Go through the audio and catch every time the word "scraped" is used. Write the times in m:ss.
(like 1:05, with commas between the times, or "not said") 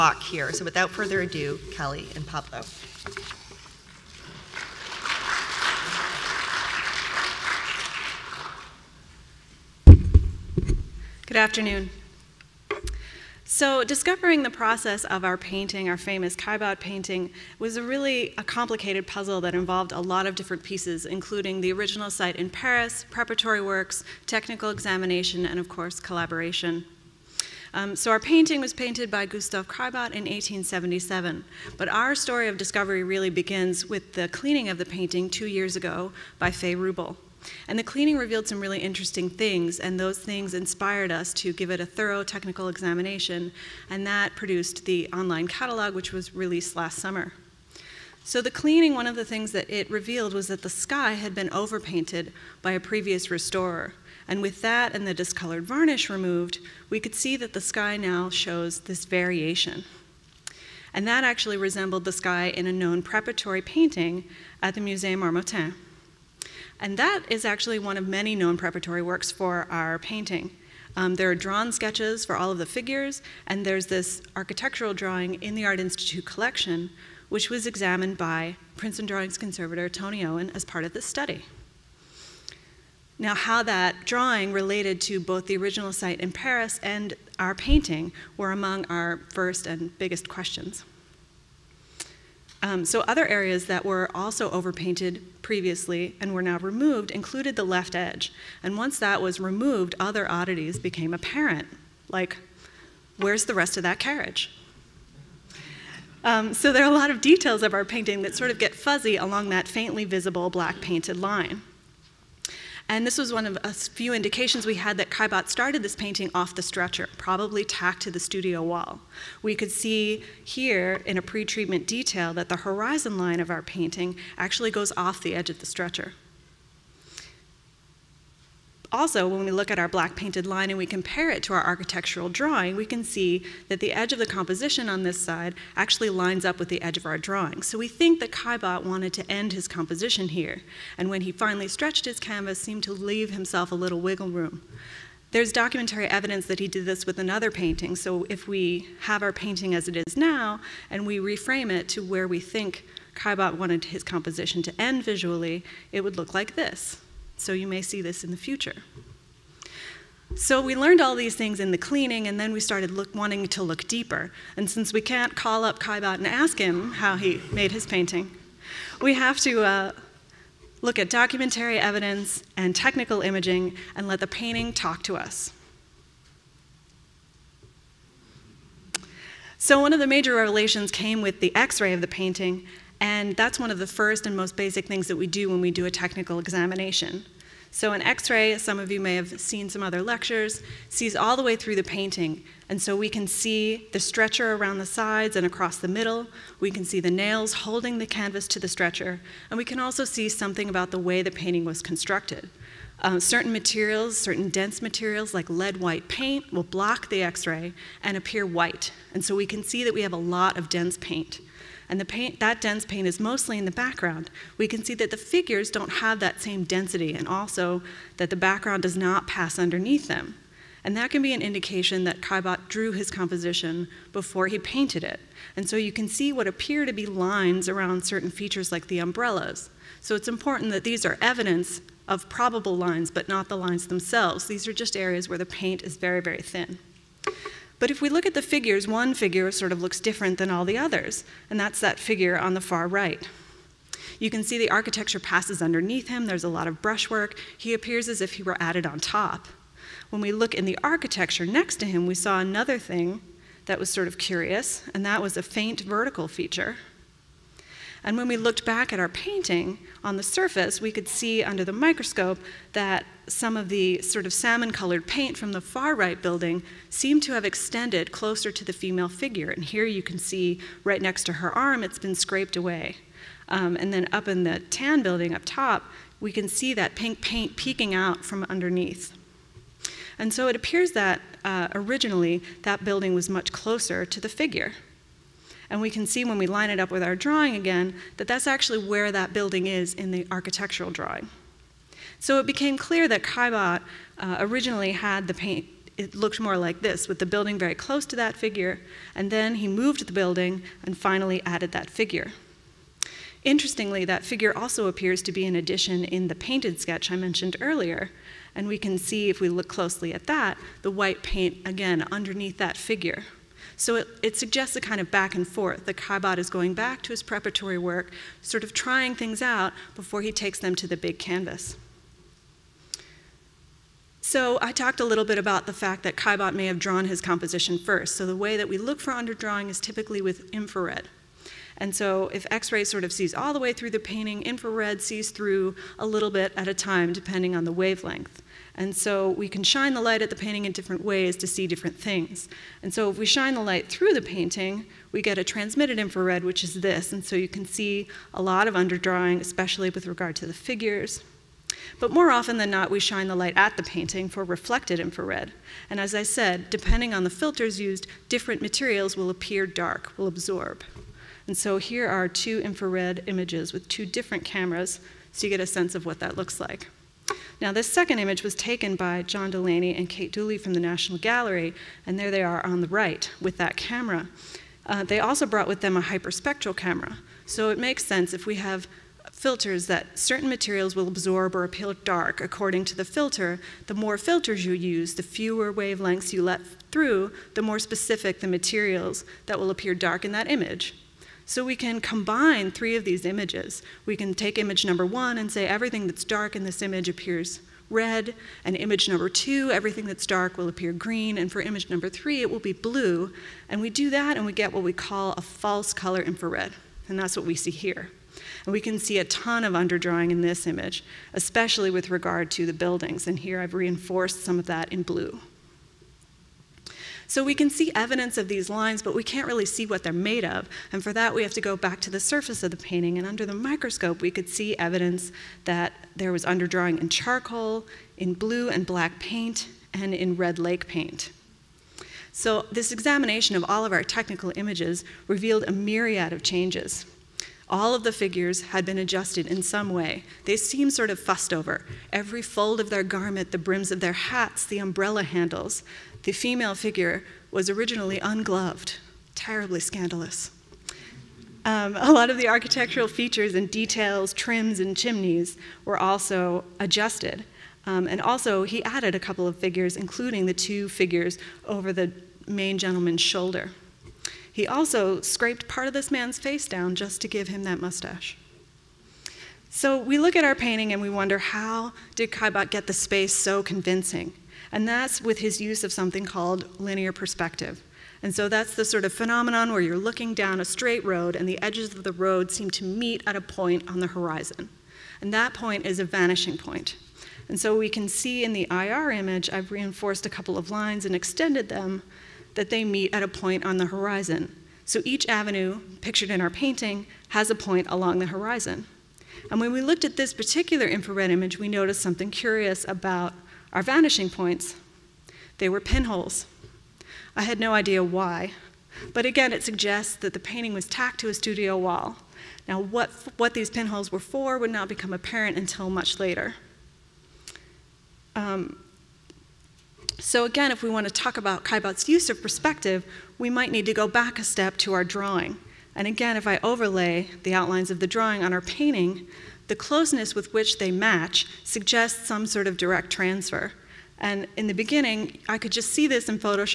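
4:32, 7:45.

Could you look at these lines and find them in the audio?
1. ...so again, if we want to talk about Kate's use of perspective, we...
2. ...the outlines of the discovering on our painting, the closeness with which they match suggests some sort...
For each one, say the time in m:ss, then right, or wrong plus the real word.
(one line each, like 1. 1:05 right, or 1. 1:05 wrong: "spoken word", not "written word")
1. 8:40 wrong: "Caillebotte", not "Kate"
2. 8:47 wrong: "drawing", not "discovering".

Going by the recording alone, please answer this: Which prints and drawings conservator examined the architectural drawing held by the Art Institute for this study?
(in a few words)
Tony Owen.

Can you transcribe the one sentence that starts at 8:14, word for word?
So each avenue, pictured in our painting, has a point along the horizon.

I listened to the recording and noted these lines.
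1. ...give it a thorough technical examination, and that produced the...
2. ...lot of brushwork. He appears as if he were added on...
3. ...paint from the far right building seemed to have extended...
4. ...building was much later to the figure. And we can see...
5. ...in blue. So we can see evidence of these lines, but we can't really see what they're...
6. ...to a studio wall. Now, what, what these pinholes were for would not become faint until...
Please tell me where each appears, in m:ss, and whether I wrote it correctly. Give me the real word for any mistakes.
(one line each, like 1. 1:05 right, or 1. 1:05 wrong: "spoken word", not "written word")
1. 0:41 right
2. 4:06 right
3. 4:25 right
4. 4:42 wrong: "closer", not "later"
5. 6:54 right
6. 8:31 wrong: "apparent", not "faint".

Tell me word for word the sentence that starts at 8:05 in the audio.
And that point is a vanishing point.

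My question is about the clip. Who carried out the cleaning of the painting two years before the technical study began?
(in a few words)
Faye Wrubel.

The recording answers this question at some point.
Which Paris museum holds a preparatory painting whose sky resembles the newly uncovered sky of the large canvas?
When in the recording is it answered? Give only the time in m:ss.
1:04.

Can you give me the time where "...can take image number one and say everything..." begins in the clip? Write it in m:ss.
6:34.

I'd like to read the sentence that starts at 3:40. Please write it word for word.
And that can be an indication that Caillebotte drew his composition before he painted it.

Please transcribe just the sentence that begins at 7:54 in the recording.
And that's with his use of something called linear perspective.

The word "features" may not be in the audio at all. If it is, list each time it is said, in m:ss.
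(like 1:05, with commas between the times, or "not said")
3:48, 4:16, 7:33.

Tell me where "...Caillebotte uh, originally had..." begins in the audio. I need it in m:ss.
4:53.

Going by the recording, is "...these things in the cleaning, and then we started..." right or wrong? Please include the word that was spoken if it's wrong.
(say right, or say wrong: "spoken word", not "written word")
right.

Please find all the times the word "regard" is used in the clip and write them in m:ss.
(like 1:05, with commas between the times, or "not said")
5:50, 6:52.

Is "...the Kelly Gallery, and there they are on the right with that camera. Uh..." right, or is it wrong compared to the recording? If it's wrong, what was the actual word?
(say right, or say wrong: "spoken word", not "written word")
wrong: "National", not "Kelly".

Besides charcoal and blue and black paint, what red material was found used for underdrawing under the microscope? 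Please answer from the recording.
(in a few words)
red lake paint.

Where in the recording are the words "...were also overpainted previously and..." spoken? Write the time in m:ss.
1:33.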